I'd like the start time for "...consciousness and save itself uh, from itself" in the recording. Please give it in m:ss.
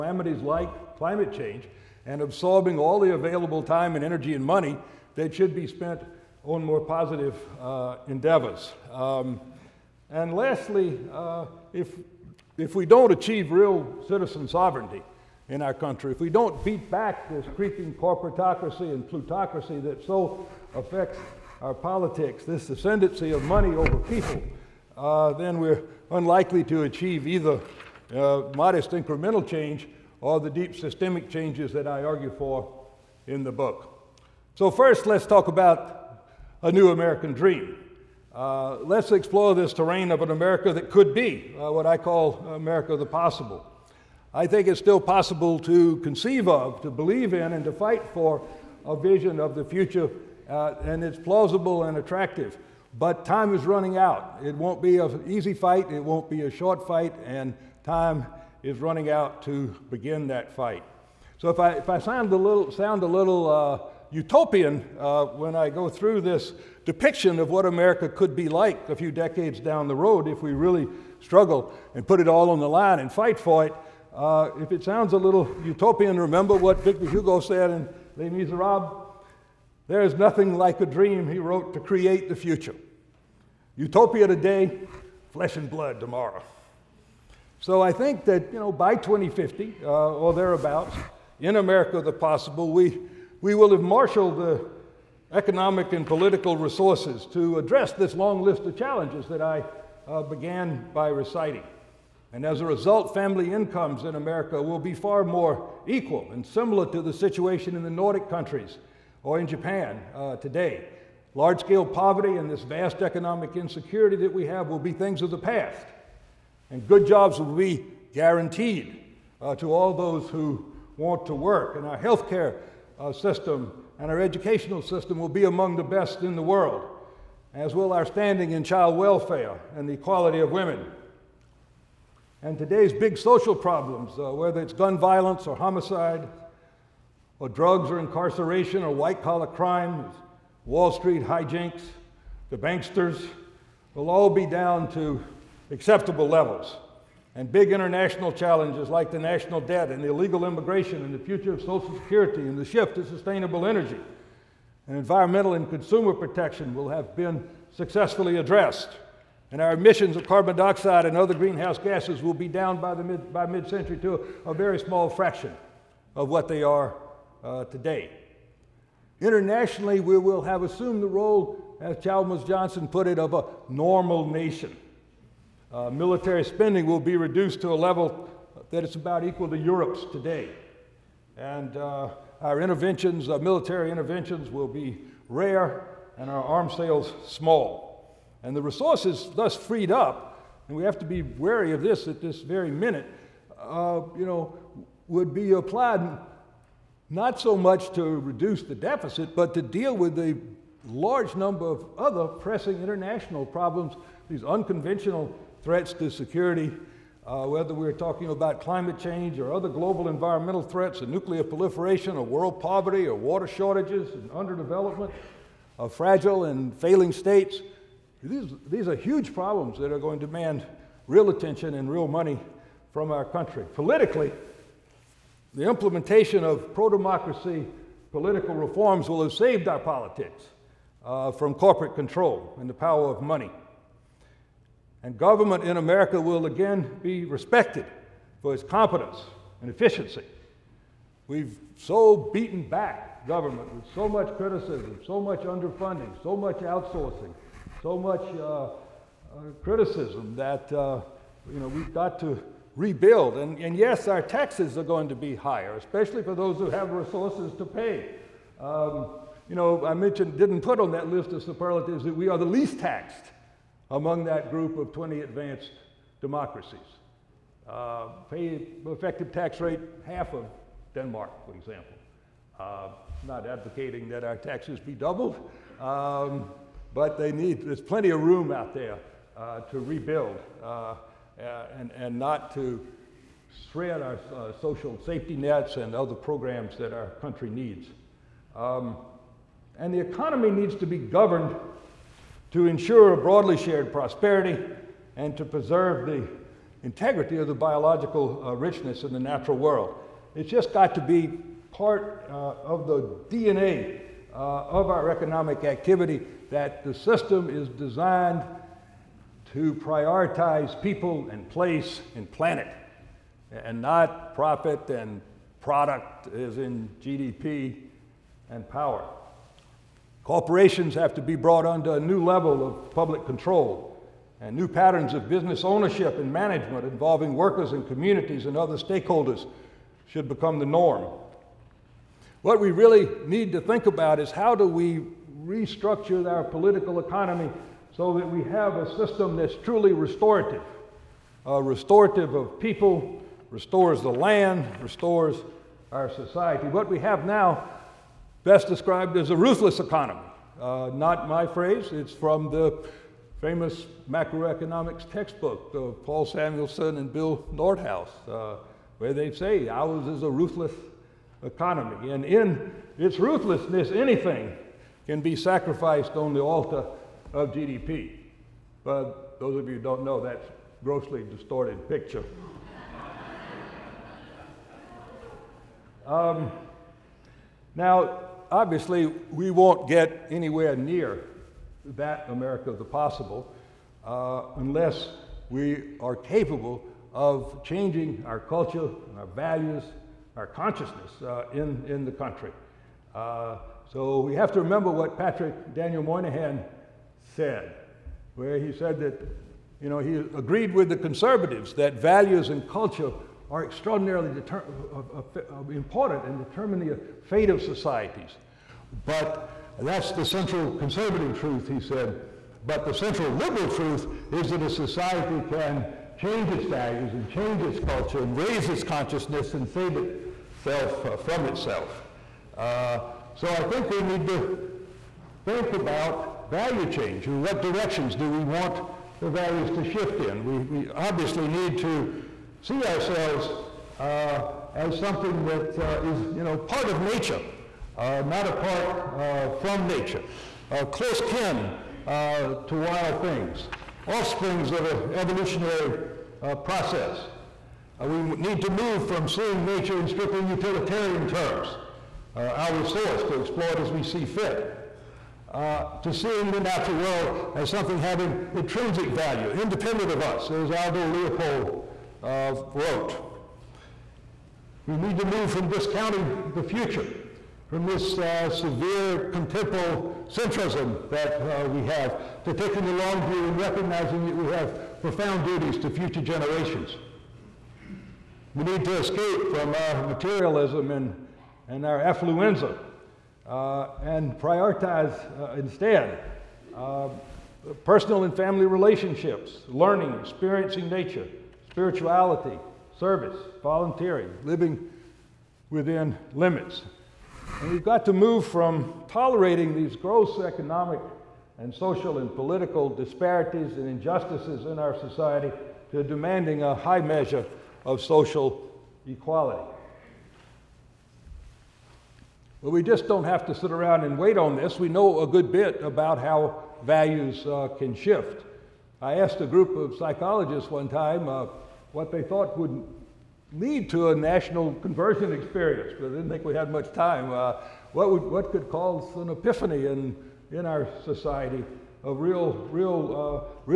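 6:58.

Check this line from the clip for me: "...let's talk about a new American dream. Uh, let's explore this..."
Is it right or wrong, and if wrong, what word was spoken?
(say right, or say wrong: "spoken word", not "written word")
right.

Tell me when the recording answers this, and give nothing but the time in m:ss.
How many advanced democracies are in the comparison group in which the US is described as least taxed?
4:24.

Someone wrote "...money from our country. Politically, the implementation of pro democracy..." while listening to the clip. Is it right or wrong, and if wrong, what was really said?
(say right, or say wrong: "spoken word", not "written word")
right.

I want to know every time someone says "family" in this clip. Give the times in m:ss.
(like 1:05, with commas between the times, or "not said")
1:43, 8:08.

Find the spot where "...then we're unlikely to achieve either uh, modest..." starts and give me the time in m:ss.
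0:25.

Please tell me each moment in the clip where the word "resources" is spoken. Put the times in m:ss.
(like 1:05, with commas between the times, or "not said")
1:36, 3:08, 4:16, 7:32.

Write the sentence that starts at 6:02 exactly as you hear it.
And in its ruthlessness, anything can be sacrificed on the altar of GDP.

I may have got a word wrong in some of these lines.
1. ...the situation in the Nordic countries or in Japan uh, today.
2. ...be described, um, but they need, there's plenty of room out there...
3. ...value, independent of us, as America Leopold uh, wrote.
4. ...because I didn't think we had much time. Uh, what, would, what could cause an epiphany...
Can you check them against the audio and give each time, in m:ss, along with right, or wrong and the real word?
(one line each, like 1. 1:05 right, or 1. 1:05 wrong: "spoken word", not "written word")
1. 1:47 right
2. 4:34 wrong: "doubled", not "described"
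3. 7:39 wrong: "Aldo", not "America"
4. 8:45 right.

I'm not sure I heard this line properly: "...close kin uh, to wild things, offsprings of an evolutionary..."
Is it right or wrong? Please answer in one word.
right.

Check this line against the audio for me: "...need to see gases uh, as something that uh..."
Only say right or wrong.
wrong.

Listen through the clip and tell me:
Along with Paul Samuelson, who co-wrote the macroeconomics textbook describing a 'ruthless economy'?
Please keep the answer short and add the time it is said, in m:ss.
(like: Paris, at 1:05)
Bill Nordhaus, at 5:57.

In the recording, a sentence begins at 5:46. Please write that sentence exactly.
What we have now best described as a ruthless economy.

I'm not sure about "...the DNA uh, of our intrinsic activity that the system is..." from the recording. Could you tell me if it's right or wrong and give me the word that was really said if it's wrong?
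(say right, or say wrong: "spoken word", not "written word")
wrong: "economic", not "intrinsic".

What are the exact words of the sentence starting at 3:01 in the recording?
And uh, our interventions, uh, military interventions, will be rare and our arms sales small.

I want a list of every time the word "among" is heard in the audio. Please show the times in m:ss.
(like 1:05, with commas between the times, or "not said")
2:05, 4:23.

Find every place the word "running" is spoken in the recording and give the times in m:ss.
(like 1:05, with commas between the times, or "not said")
0:53, 0:58.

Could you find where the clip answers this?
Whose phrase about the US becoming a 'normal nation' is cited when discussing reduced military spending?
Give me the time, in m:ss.
2:52.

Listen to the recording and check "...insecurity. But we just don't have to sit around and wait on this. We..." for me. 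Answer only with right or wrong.
wrong.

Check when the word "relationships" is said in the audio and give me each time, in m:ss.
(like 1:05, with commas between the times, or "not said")
8:08.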